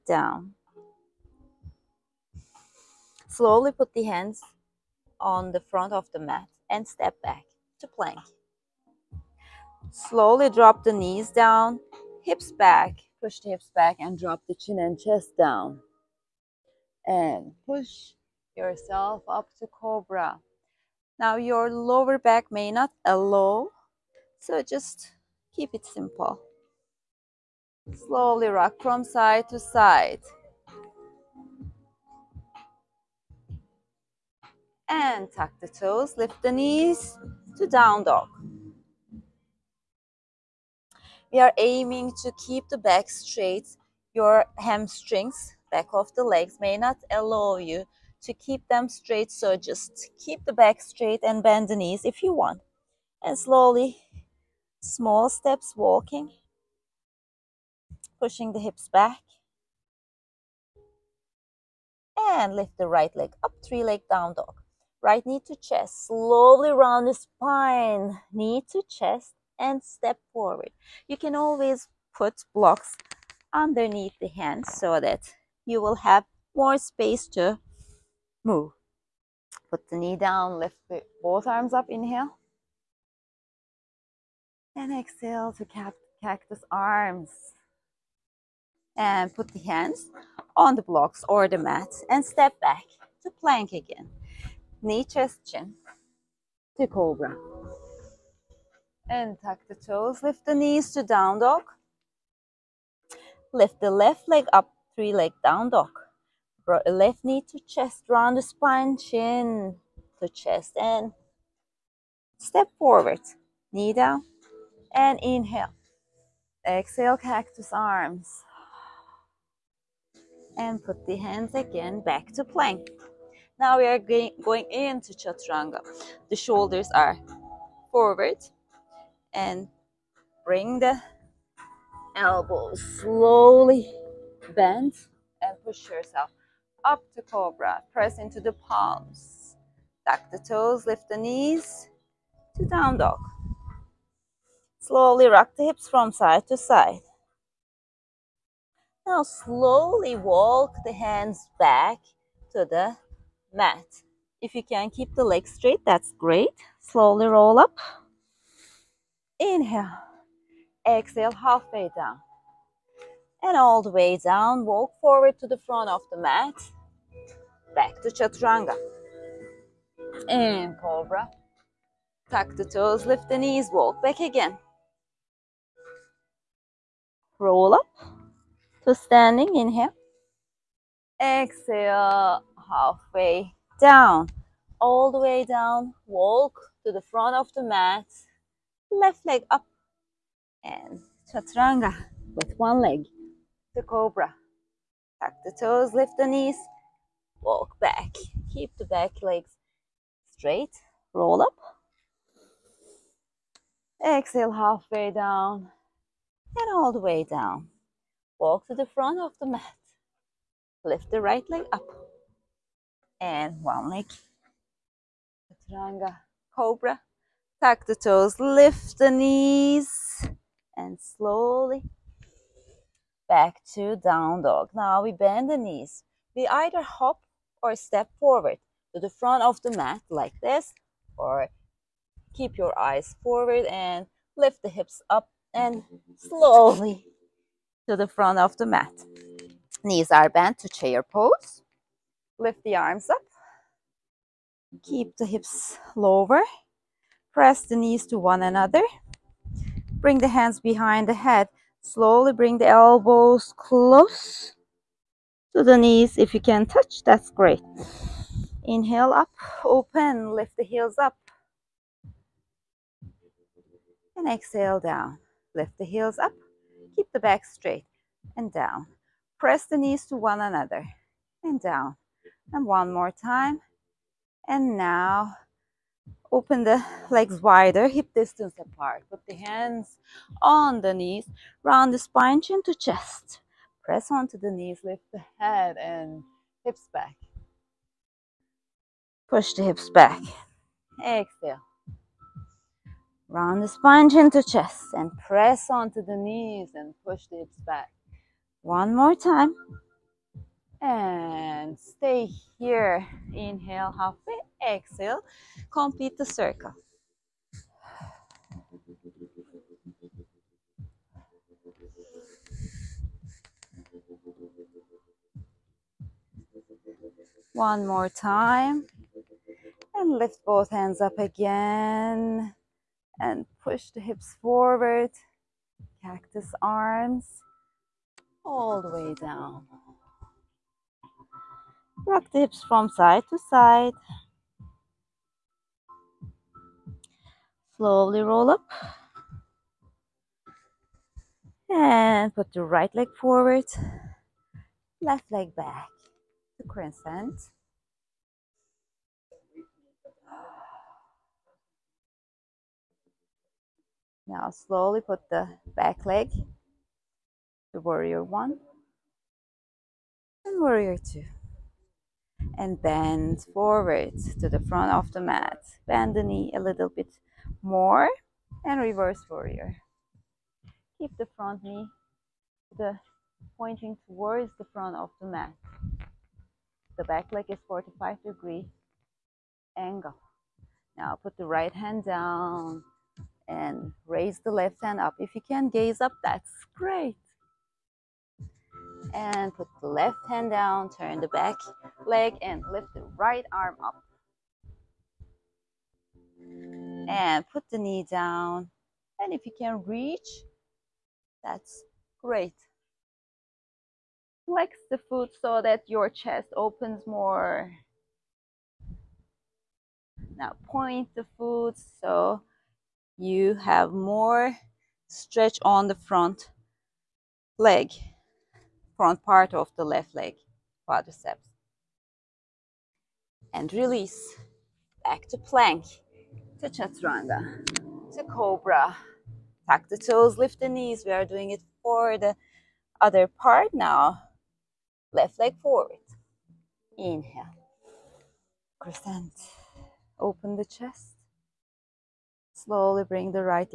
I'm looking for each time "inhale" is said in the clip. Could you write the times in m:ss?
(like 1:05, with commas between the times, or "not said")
1:21, 1:55, 2:39, 2:59, 4:18, 5:03, 7:16.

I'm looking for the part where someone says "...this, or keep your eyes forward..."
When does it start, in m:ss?
3:50.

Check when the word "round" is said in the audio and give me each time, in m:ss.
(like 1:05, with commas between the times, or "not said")
1:06, 1:48, 4:41, 4:53.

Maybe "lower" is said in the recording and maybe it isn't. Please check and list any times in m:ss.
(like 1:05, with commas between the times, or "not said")
0:21, 4:05.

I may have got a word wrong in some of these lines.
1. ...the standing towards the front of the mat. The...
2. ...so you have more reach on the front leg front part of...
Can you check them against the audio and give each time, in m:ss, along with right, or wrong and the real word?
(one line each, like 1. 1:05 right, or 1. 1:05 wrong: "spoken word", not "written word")
1. 6:12 wrong: "pointing", not "standing"
2. 6:52 wrong: "stretch", not "reach".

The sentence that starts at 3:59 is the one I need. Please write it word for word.
Knees are bent to chair pose.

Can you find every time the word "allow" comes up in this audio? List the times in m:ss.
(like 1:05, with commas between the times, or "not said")
0:23, 0:47.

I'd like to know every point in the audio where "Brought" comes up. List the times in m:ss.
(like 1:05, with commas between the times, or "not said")
1:46.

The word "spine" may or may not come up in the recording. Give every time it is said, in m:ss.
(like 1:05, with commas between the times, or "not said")
1:07, 1:48, 4:41, 4:53.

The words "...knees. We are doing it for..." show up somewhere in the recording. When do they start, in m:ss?
7:10.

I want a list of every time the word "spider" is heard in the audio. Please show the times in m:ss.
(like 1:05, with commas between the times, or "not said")
not said.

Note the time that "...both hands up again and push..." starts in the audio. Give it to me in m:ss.
5:20.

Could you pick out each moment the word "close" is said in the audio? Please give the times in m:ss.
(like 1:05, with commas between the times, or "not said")
4:13.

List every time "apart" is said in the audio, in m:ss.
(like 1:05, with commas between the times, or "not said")
4:38.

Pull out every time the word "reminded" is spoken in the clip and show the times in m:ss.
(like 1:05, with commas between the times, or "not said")
not said.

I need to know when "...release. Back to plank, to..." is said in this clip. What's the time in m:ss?
7:03.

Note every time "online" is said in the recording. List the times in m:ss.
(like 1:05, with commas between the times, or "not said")
not said.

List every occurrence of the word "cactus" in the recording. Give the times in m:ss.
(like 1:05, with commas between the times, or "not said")
1:26, 1:57, 5:26.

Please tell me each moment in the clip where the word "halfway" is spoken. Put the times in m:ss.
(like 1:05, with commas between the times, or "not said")
2:41, 3:02, 3:24, 5:03.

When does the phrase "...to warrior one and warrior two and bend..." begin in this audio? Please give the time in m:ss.
5:57.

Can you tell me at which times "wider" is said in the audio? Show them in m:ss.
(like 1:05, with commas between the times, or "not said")
4:37.